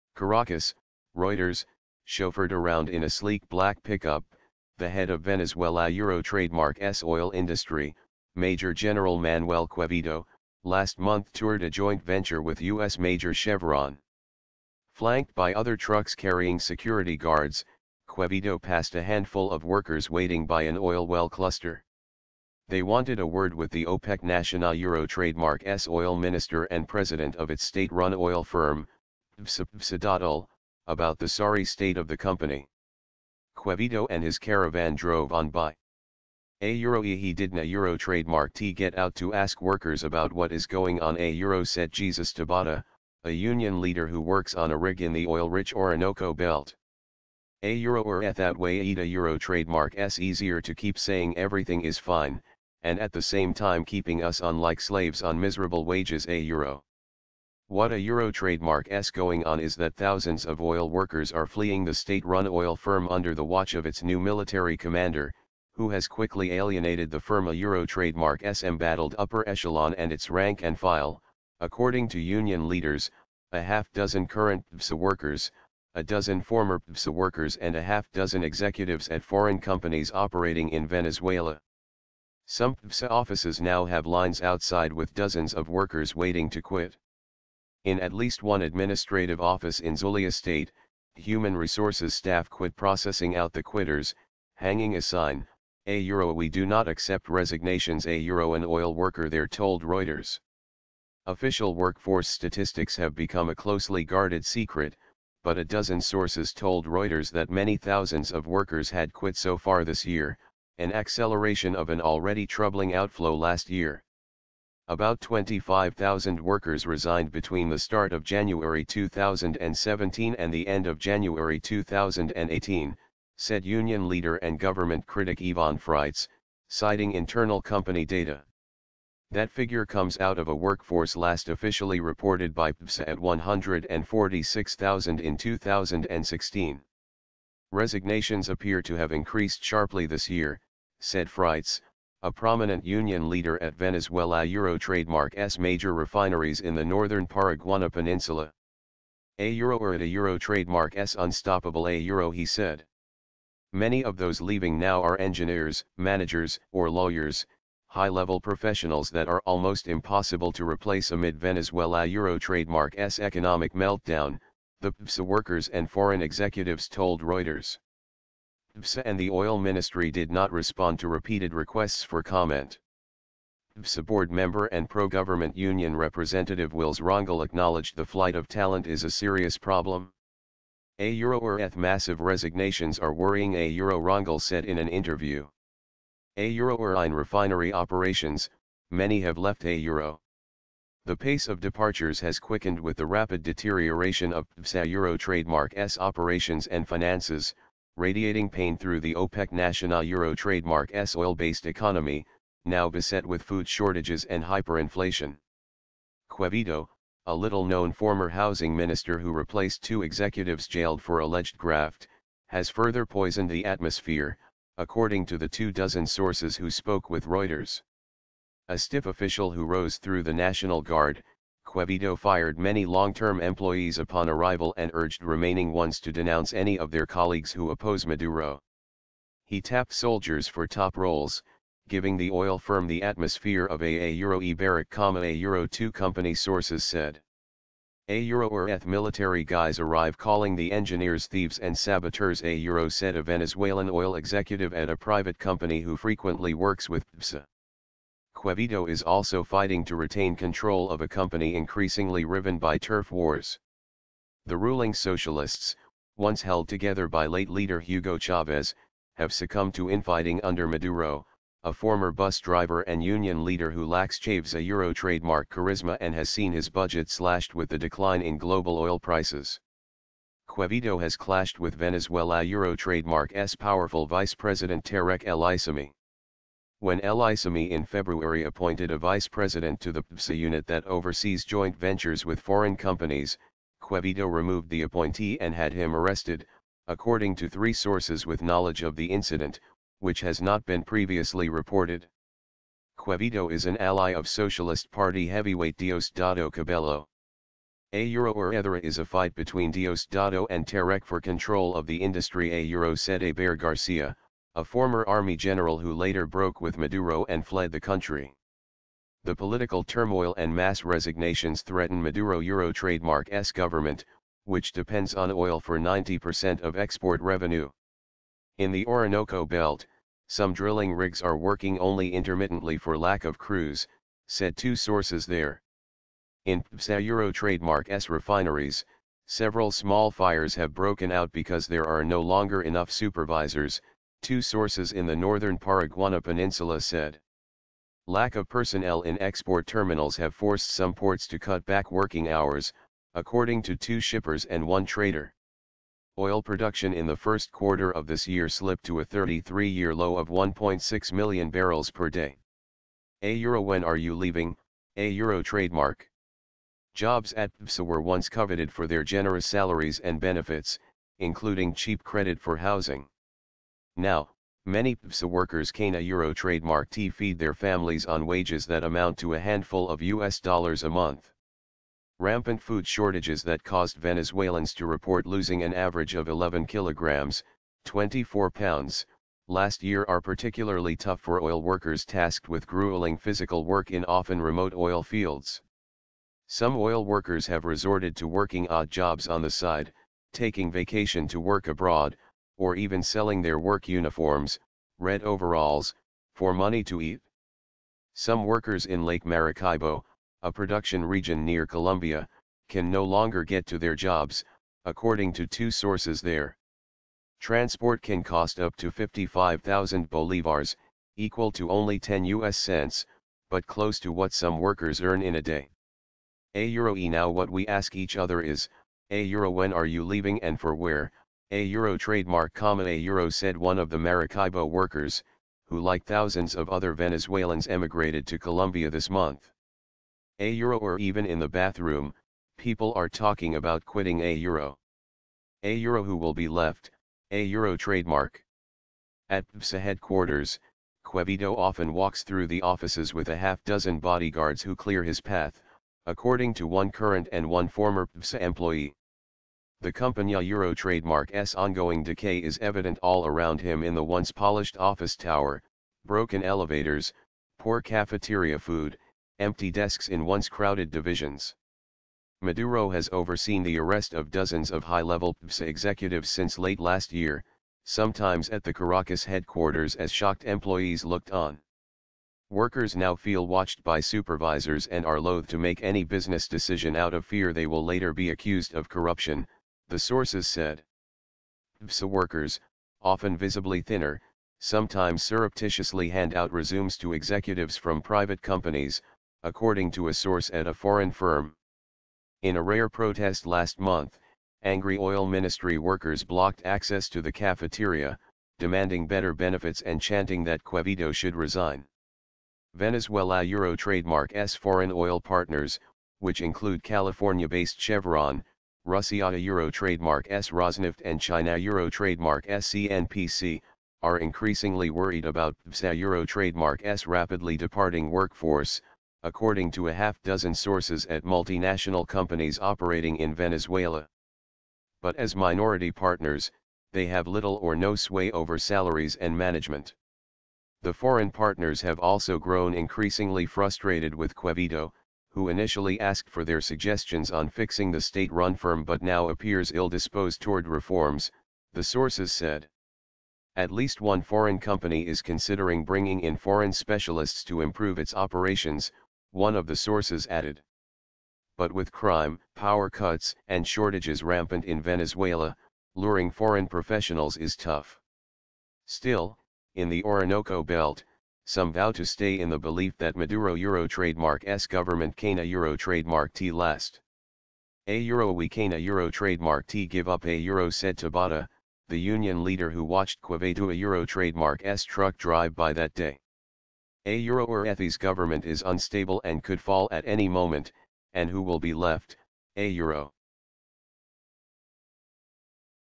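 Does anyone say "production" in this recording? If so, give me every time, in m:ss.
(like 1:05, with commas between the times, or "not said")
5:46, 6:40.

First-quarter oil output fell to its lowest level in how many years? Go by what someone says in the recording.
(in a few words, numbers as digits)
33.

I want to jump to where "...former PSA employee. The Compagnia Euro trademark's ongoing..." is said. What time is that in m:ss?
7:27.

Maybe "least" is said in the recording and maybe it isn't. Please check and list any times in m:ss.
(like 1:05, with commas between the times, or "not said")
1:28, 9:03.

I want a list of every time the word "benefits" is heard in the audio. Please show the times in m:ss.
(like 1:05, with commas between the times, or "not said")
6:00, 8:19.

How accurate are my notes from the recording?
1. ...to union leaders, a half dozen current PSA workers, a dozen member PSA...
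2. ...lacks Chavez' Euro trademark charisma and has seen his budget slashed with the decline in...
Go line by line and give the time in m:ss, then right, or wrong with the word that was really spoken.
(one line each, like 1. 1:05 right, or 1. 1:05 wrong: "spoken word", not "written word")
1. 1:12 wrong: "former", not "member"
2. 4:23 right.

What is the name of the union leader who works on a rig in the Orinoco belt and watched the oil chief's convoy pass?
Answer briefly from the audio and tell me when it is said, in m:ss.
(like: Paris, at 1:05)
Jesus Tabata, at 0:41.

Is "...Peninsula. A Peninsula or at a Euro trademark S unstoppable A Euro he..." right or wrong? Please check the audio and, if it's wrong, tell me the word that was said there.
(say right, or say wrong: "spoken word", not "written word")
wrong: "Euro", not "Peninsula".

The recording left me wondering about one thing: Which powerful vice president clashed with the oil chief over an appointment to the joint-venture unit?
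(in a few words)
Tarek El Aissami.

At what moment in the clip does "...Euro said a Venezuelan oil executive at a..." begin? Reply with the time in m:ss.
4:02.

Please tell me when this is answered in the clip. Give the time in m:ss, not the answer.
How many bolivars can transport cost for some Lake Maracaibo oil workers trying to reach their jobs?
6:48.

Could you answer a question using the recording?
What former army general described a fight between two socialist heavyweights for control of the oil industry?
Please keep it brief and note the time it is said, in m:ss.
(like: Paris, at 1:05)
Hebert Garcia, at 5:03.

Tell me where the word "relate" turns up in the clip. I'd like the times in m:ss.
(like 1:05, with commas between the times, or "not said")
not said.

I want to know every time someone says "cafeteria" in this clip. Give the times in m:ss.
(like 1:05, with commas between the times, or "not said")
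7:37, 8:17.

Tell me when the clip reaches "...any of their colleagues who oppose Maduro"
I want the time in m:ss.
3:46.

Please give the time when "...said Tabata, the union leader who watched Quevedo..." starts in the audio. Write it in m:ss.
9:30.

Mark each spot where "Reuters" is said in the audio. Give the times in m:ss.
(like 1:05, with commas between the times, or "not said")
0:01, 1:39, 1:46, 2:47, 3:37.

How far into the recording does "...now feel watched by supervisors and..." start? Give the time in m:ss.
7:52.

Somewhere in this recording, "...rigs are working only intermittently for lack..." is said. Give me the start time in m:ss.
5:20.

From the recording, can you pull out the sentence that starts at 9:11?
But with crime, power cuts, and shortages rampant in Venezuela, luring foreign professionals is tough.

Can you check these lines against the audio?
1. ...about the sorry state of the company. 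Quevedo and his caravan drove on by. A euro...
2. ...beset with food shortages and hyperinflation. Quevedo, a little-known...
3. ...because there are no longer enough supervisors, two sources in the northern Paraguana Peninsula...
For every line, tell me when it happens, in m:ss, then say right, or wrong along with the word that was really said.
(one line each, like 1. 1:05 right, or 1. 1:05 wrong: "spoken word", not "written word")
1. 0:30 right
2. 3:22 right
3. 5:31 right.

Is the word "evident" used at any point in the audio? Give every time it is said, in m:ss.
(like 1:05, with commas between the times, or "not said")
7:32.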